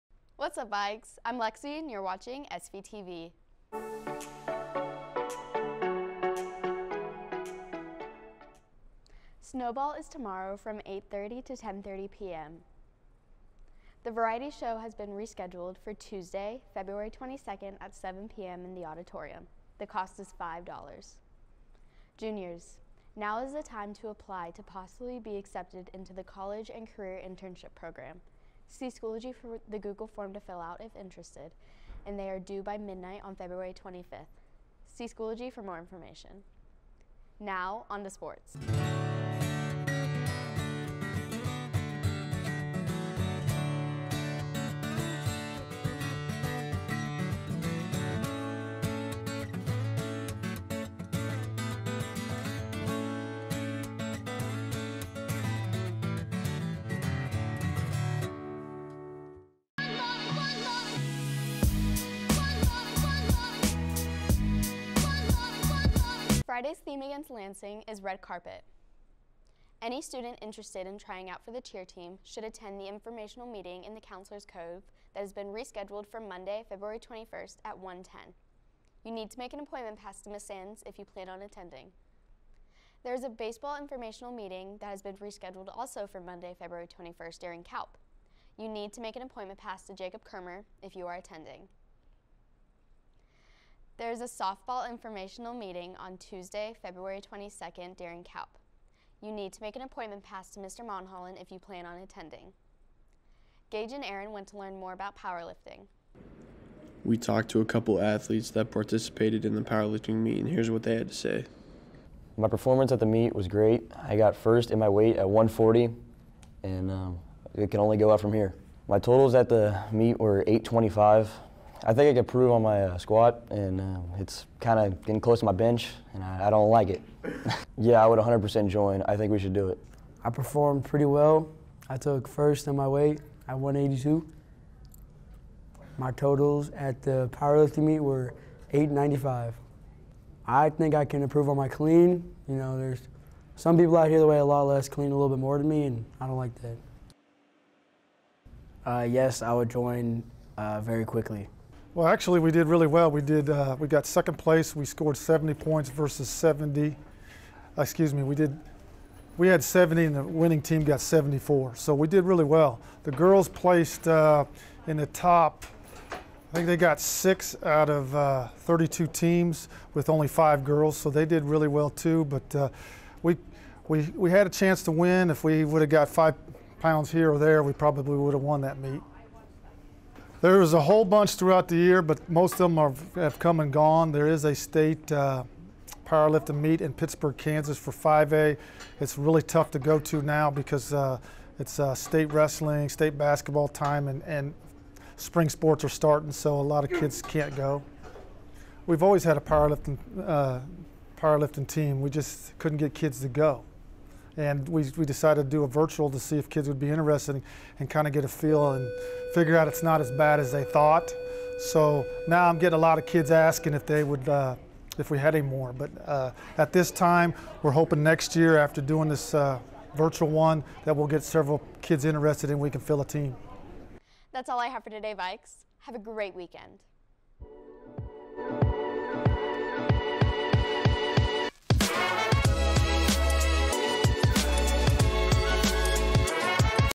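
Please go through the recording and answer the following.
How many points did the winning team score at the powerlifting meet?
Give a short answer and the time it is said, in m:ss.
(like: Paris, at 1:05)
74, at 2:41.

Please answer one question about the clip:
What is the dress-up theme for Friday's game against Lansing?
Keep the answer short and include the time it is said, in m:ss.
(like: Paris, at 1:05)
red carpet, at 1:08.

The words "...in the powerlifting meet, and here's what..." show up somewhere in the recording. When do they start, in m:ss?
1:49.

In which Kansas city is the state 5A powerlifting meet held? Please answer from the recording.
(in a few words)
Pittsburg.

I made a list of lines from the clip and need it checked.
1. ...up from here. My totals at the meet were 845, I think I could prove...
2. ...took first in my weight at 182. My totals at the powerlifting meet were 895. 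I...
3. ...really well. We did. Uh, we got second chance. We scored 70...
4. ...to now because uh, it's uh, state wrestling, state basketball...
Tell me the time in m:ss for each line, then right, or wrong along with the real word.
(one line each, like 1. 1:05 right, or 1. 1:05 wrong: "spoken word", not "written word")
1. 1:58 wrong: "825", not "845"
2. 2:11 right
3. 2:32 wrong: "place", not "chance"
4. 3:09 right.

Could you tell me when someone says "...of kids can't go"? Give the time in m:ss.
3:16.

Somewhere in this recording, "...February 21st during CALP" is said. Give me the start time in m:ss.
1:26.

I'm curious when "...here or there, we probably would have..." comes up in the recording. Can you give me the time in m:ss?
2:57.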